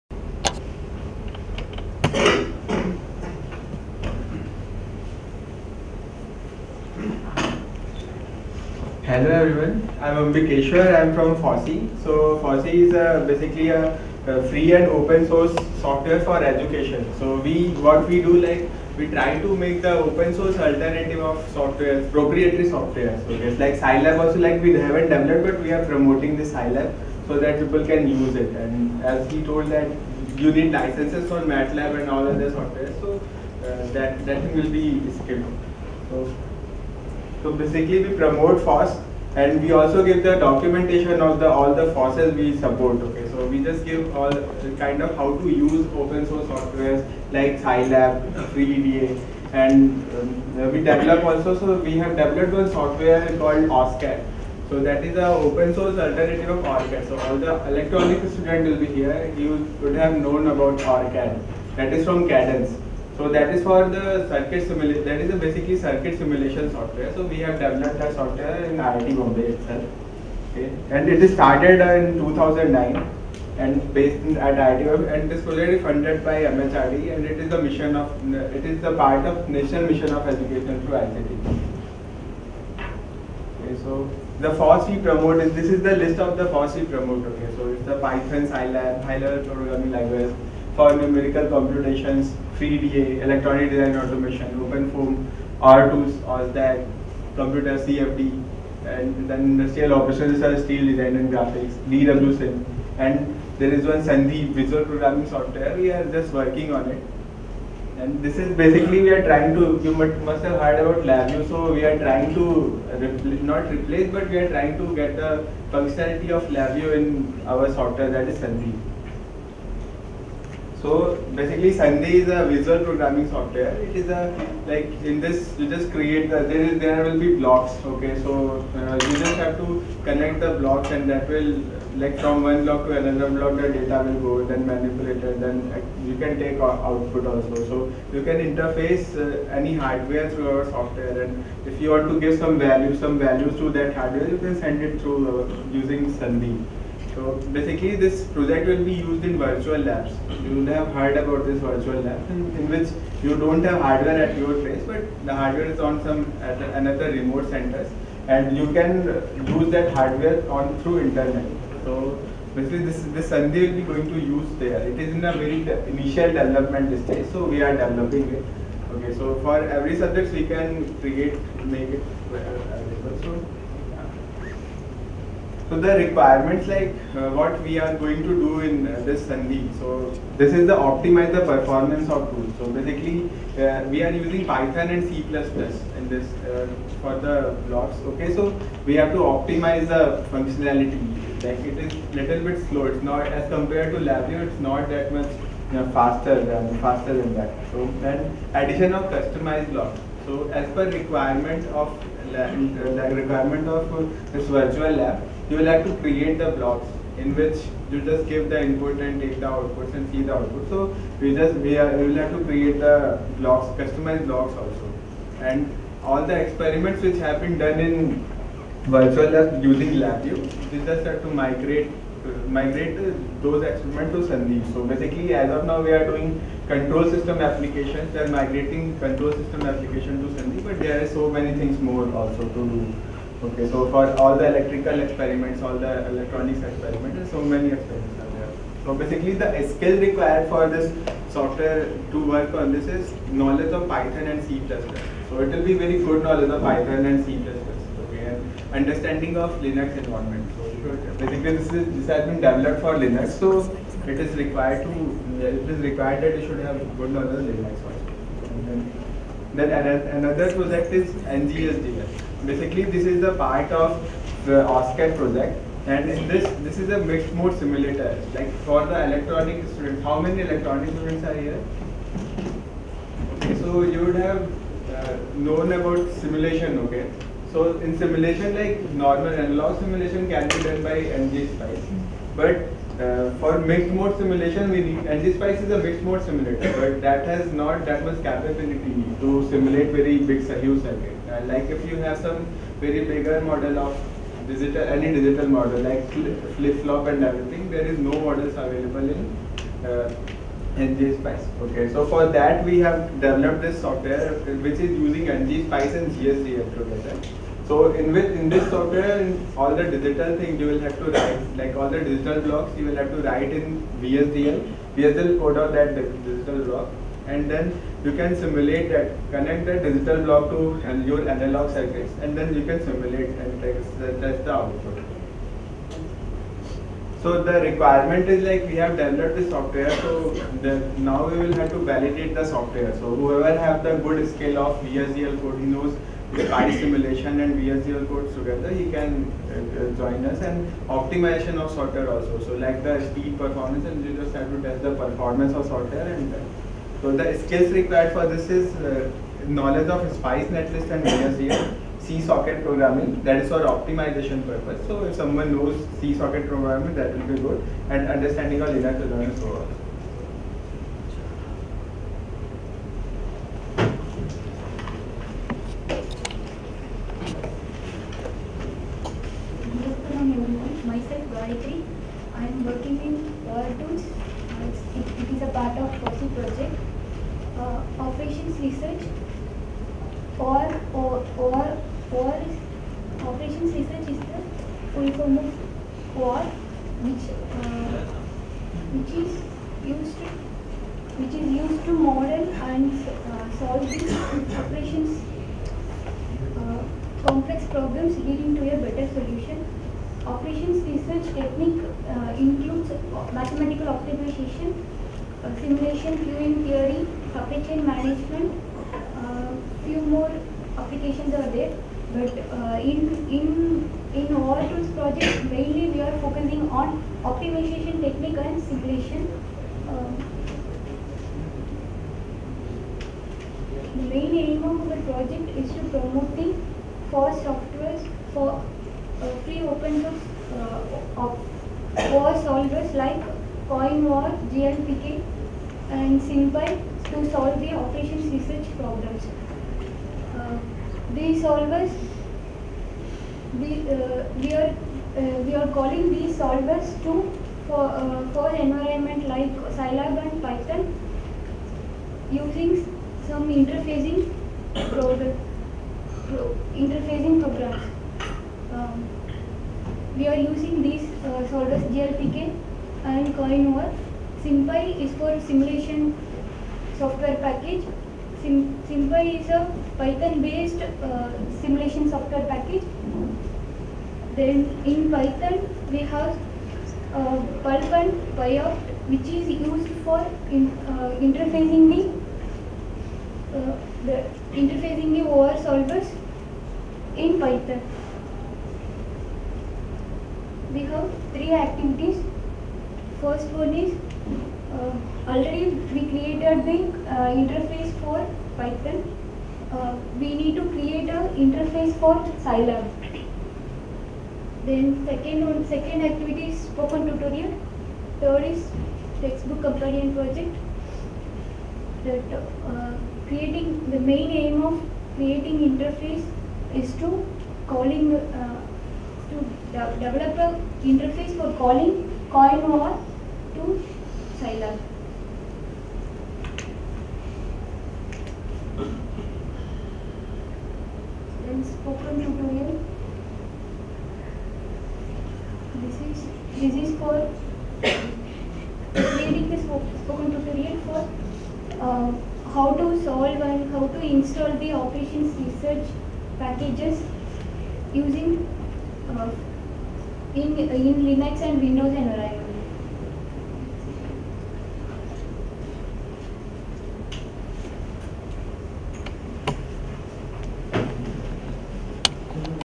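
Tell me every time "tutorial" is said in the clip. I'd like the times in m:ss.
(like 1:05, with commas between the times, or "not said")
8:27, 8:52, 9:00.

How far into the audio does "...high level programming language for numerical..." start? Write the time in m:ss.
1:29.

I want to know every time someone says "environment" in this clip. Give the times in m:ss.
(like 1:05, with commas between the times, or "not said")
4:09, 7:28, 9:11.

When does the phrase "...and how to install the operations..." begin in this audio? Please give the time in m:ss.
9:03.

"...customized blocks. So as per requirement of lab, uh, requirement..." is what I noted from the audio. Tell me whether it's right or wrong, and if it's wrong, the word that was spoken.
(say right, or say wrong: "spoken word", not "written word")
right.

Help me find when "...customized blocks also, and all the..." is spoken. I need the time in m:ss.
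3:33.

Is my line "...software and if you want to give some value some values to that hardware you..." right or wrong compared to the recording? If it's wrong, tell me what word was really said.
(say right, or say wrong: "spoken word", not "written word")
right.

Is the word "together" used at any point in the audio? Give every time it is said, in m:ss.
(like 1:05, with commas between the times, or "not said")
5:06, 5:38.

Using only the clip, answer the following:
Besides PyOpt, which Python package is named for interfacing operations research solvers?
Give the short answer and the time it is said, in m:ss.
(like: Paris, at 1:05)
Pulp, at 7:57.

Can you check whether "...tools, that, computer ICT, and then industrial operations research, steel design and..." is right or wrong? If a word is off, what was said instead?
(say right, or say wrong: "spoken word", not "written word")
wrong: "CFD", not "ICT".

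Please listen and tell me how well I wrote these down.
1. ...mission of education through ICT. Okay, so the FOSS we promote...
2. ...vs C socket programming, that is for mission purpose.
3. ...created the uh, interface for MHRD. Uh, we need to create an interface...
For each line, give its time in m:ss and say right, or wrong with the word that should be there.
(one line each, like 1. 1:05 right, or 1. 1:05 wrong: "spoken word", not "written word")
1. 1:19 right
2. 5:51 wrong: "optimization", not "mission"
3. 8:16 wrong: "Python", not "MHRD".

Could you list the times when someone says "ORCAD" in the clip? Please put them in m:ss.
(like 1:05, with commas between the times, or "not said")
0:56, 1:00.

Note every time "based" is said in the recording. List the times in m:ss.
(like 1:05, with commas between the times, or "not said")
1:13, 7:50.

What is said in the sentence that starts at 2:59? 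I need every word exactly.
So this is the optimize the performance of tool.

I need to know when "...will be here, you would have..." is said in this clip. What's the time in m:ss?
0:58.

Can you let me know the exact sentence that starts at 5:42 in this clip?
So like the speed performance and you just have to test the performance of sorter.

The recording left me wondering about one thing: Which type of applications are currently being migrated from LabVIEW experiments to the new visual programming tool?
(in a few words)
control system applications.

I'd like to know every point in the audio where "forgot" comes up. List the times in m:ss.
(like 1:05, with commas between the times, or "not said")
not said.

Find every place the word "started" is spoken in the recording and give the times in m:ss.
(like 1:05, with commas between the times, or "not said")
1:11.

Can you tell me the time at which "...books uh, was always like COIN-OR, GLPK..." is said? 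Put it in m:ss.
7:10.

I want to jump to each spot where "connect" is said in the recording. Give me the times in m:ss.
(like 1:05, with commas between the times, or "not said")
2:10, 5:19.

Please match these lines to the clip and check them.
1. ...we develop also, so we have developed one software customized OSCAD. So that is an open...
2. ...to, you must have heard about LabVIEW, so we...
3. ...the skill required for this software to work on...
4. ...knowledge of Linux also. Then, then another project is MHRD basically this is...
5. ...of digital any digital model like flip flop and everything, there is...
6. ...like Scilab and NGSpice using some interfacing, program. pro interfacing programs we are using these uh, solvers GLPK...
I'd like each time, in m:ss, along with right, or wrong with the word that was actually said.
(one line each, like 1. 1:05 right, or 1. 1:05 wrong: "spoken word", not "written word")
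1. 0:50 wrong: "called", not "customized"
2. 1:49 right
3. 3:59 right
4. 4:17 wrong: "NGHDL", not "MHRD"
5. 4:53 right
6. 7:29 wrong: "Python", not "NGSpice".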